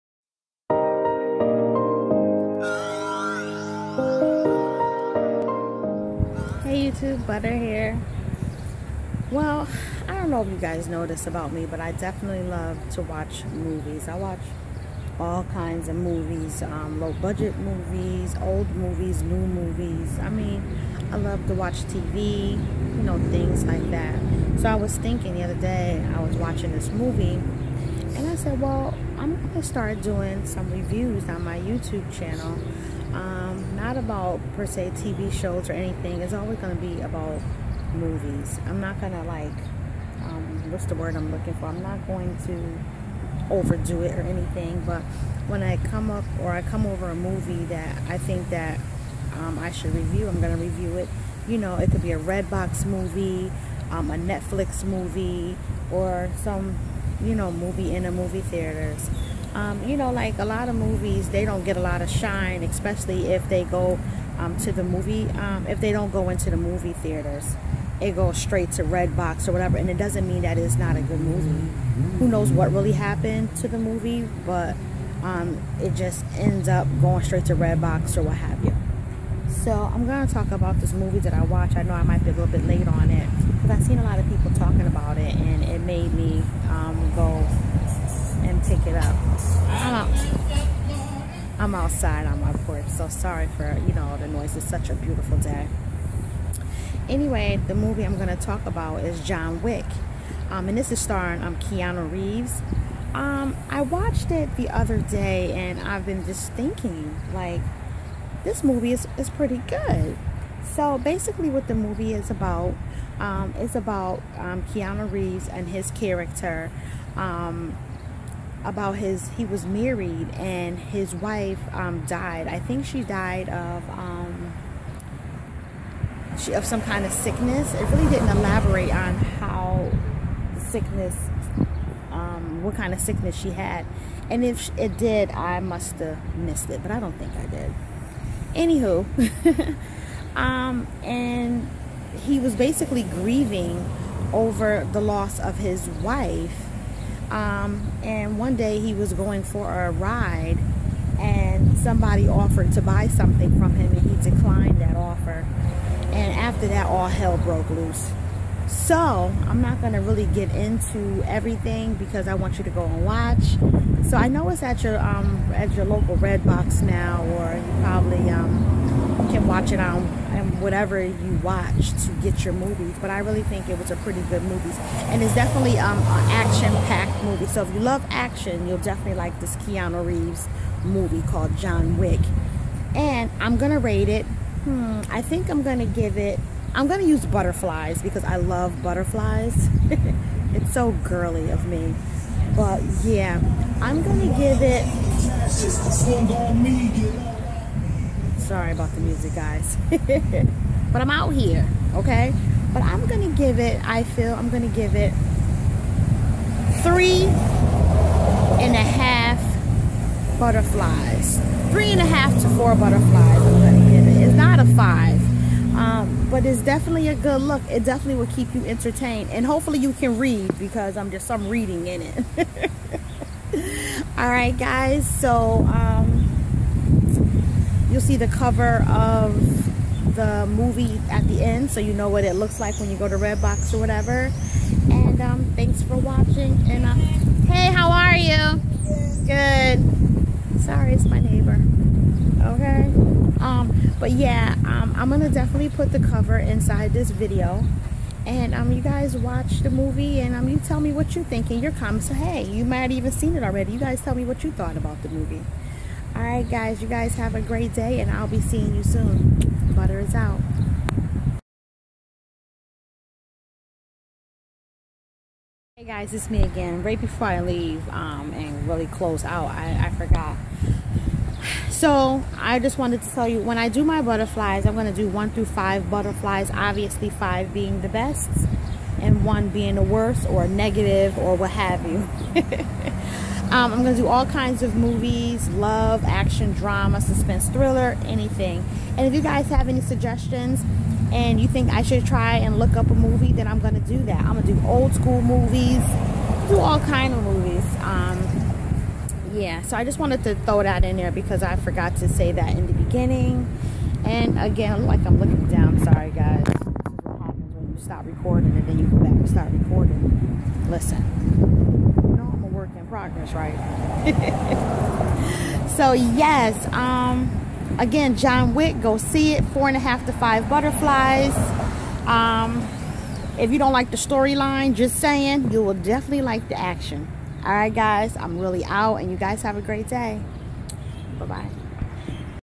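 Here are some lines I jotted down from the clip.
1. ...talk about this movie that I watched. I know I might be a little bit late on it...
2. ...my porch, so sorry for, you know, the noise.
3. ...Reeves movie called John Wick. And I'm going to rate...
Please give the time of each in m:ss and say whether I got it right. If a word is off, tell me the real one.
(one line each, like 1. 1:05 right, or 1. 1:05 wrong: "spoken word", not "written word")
1. 1:20 right
2. 1:32 right
3. 3:00 right.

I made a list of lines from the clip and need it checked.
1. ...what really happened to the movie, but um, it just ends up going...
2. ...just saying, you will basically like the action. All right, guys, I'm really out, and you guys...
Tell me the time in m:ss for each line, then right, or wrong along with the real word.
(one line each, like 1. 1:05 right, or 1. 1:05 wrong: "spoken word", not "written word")
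1. 1:12 right
2. 5:24 wrong: "definitely", not "basically".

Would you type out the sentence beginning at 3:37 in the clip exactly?
It definitely will keep you entertained.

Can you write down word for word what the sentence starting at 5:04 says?
And again, like I'm looking down, sorry guys.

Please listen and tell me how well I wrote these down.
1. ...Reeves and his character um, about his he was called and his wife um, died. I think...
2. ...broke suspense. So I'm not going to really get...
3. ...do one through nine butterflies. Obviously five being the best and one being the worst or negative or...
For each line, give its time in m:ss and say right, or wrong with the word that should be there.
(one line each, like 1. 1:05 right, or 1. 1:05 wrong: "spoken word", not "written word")
1. 1:55 wrong: "married", not "called"
2. 2:37 wrong: "loose", not "suspense"
3. 4:34 wrong: "five", not "nine".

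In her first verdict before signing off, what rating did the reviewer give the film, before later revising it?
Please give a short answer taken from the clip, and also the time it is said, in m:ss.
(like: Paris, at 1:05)
3.5 to 4 butterflies, at 3:31.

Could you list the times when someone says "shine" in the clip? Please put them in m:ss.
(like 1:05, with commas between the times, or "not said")
1:02.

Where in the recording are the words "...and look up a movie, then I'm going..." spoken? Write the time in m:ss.
4:52.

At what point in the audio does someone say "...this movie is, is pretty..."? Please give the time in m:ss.
1:48.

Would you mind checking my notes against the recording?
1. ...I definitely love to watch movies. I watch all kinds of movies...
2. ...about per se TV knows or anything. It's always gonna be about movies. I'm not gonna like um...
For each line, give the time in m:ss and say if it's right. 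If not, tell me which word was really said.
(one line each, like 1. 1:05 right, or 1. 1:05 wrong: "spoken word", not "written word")
1. 0:11 right
2. 0:33 wrong: "shows", not "knows".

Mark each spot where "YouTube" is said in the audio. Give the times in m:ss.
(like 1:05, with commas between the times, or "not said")
0:07, 0:31.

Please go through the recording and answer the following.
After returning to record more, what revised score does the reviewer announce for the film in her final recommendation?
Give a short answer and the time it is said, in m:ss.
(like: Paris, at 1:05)
4.5 to 5 butterflies, at 5:19.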